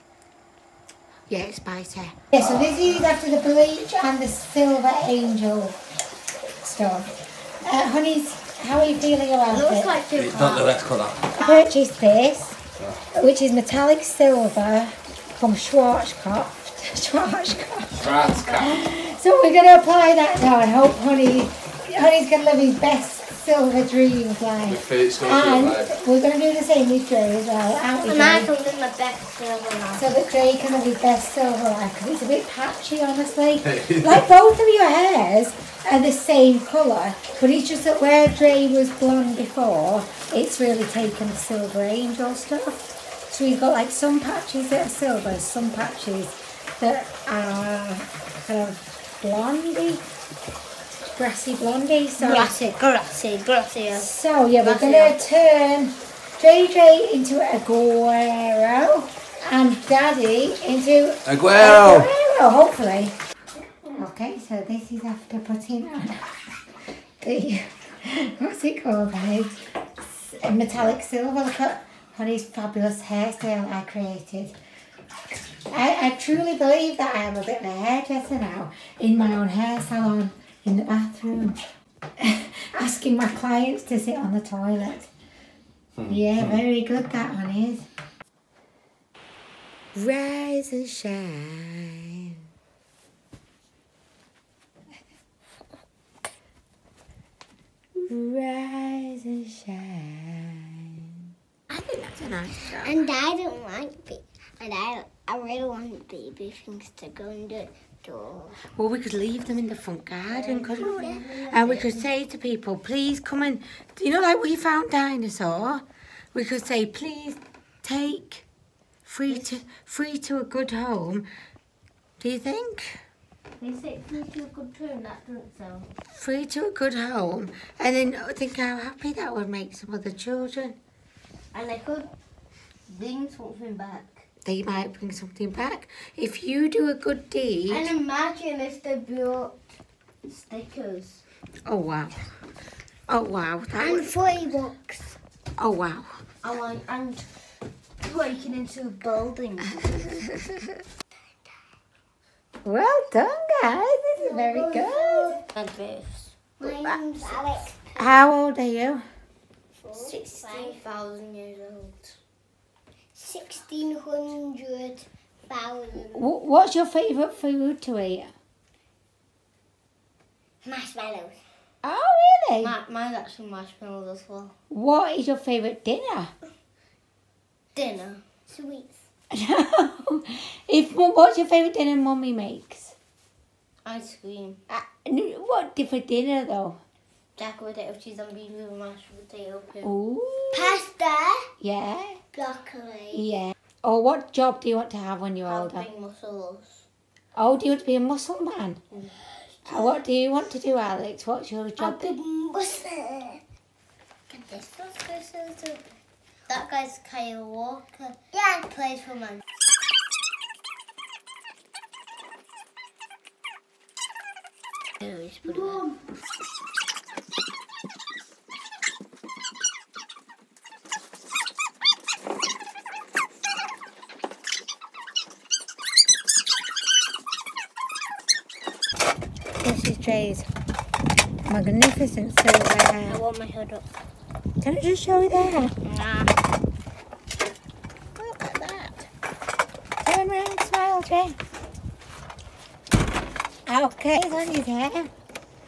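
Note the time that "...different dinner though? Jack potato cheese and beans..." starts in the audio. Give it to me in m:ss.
3:05.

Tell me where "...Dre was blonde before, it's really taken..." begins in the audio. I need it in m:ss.
0:38.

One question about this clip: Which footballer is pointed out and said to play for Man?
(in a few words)
Kyle Walker.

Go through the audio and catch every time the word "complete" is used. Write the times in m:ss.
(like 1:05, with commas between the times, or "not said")
not said.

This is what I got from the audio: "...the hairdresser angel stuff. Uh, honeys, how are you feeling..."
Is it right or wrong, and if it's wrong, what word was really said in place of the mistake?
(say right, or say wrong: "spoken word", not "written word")
wrong: "silver", not "hairdresser".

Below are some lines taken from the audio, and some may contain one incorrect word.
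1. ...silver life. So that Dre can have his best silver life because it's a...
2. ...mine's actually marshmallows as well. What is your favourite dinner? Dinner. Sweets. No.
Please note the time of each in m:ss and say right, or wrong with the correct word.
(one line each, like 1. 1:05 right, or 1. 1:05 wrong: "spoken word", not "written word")
1. 0:29 right
2. 2:52 right.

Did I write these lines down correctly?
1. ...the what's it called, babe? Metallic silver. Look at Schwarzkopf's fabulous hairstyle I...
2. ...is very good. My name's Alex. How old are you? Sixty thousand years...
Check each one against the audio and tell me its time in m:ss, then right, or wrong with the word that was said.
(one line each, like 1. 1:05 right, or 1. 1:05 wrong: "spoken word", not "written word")
1. 1:07 wrong: "Honey", not "Schwarzkopf"
2. 2:34 right.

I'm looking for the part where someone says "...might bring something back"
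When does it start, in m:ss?
2:14.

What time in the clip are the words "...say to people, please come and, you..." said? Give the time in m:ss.
1:51.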